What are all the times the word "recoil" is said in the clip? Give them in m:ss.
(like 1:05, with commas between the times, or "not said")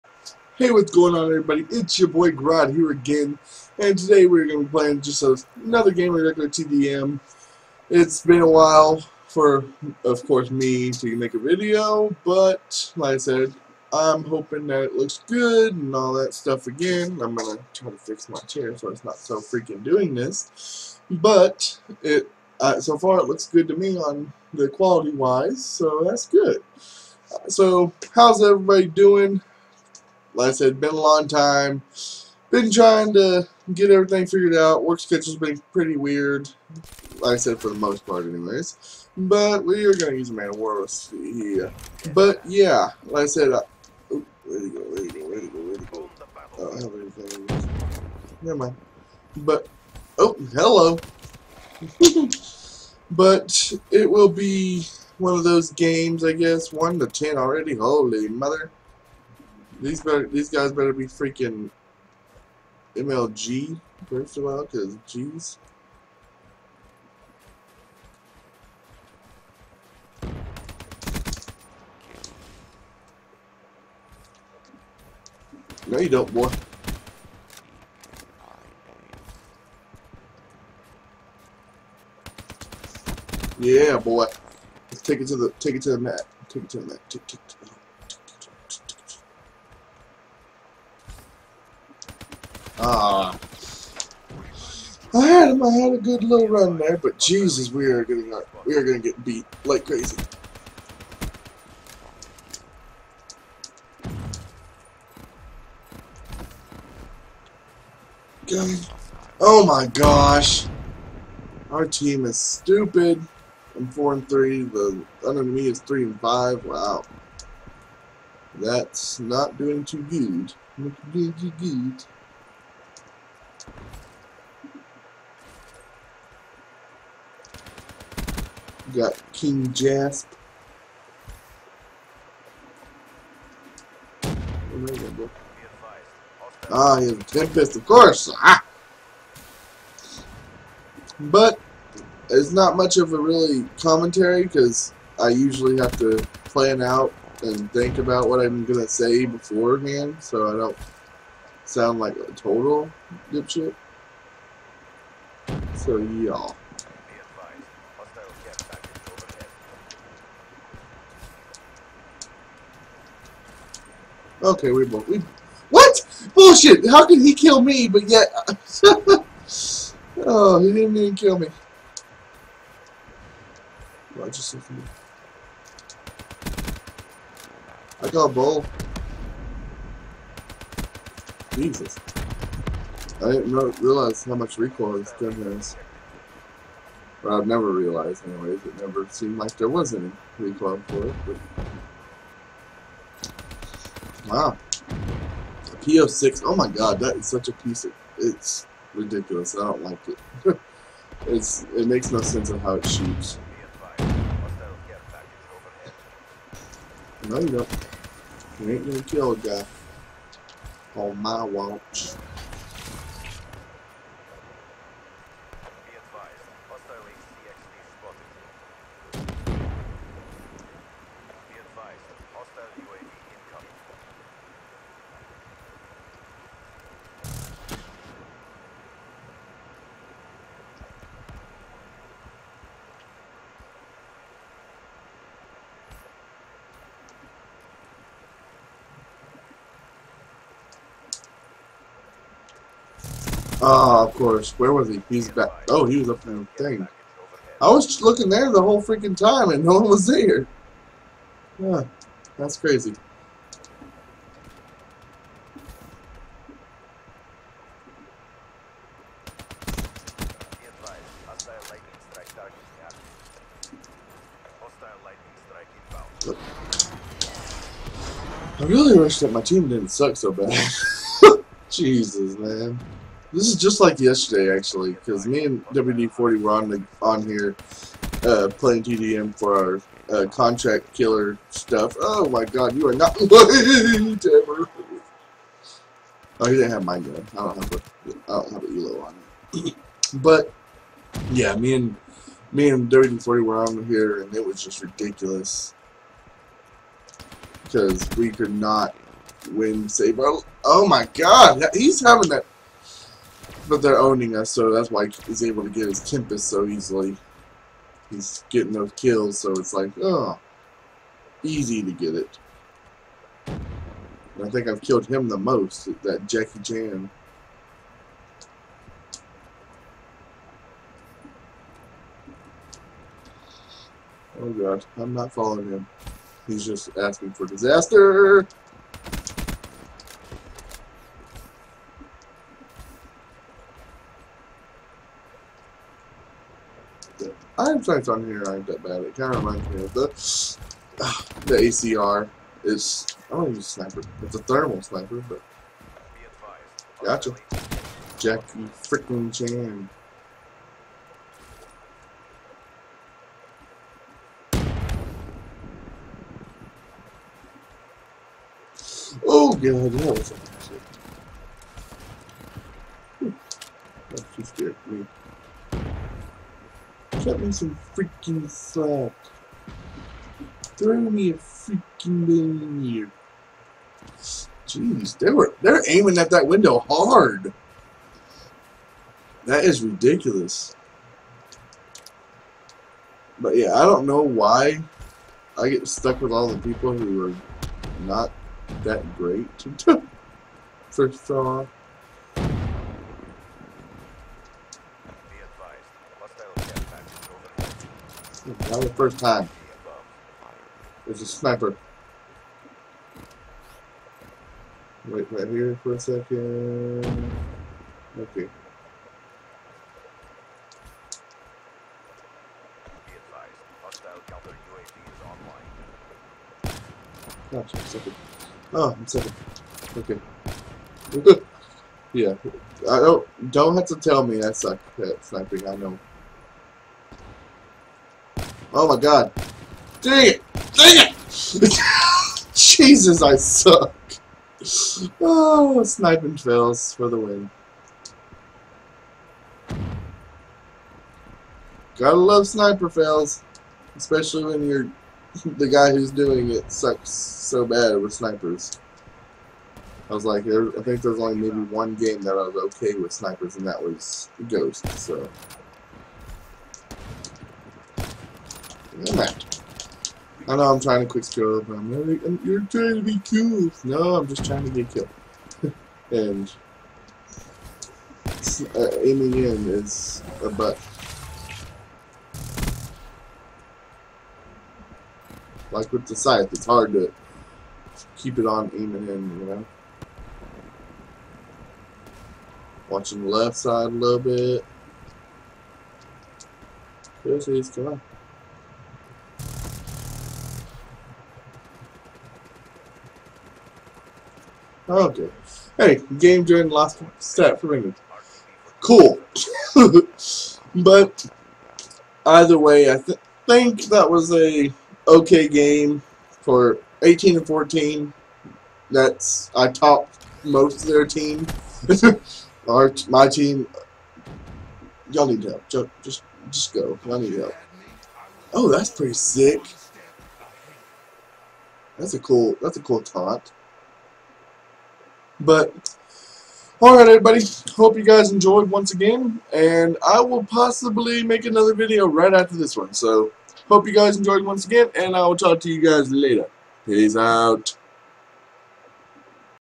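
3:04, 3:10.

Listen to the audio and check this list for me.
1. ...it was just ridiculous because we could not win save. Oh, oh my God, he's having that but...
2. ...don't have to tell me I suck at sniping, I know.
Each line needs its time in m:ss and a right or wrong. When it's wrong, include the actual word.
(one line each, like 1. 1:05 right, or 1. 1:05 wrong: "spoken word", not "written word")
1. 4:54 right
2. 7:03 right.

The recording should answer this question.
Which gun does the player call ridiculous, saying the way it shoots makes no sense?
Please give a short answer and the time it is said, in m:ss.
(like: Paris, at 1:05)
PO6, at 3:15.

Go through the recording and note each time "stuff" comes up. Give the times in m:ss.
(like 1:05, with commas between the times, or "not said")
0:16, 4:41.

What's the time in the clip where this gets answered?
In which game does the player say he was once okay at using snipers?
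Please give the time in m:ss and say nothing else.
7:34.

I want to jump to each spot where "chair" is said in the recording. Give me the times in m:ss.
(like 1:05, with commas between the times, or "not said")
0:18.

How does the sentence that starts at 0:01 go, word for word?
It's your boy Grad here again, and today we're going to be playing just another game of regular TDM.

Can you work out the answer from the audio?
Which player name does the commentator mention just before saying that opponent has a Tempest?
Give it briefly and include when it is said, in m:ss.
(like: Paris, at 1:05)
King Jasp, at 2:09.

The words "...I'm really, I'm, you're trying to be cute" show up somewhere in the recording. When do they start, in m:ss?
7:41.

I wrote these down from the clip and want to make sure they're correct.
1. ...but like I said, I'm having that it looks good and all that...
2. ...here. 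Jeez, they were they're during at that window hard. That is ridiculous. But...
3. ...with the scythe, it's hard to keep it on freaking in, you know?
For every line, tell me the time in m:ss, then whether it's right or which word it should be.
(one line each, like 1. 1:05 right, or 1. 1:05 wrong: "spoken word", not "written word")
1. 0:12 wrong: "hoping", not "having"
2. 6:12 wrong: "aiming", not "during"
3. 7:55 wrong: "aiming", not "freaking".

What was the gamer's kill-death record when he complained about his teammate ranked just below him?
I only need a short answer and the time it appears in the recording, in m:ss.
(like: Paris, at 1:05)
4 and 3, at 1:53.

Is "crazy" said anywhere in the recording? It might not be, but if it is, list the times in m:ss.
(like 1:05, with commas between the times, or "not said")
1:39, 4:12.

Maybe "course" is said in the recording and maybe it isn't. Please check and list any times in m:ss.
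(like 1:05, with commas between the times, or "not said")
0:10, 2:17, 4:04.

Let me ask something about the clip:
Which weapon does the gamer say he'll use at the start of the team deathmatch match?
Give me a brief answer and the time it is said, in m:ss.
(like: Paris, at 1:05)
Man-O-War, at 0:40.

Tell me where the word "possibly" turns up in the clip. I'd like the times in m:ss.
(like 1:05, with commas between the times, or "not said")
8:50.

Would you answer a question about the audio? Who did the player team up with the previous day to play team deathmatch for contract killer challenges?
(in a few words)
WD-40.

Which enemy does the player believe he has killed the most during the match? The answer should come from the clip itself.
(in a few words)
Jackie Chan.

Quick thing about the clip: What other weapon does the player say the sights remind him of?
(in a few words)
ACR.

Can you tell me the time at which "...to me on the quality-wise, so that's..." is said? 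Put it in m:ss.
0:23.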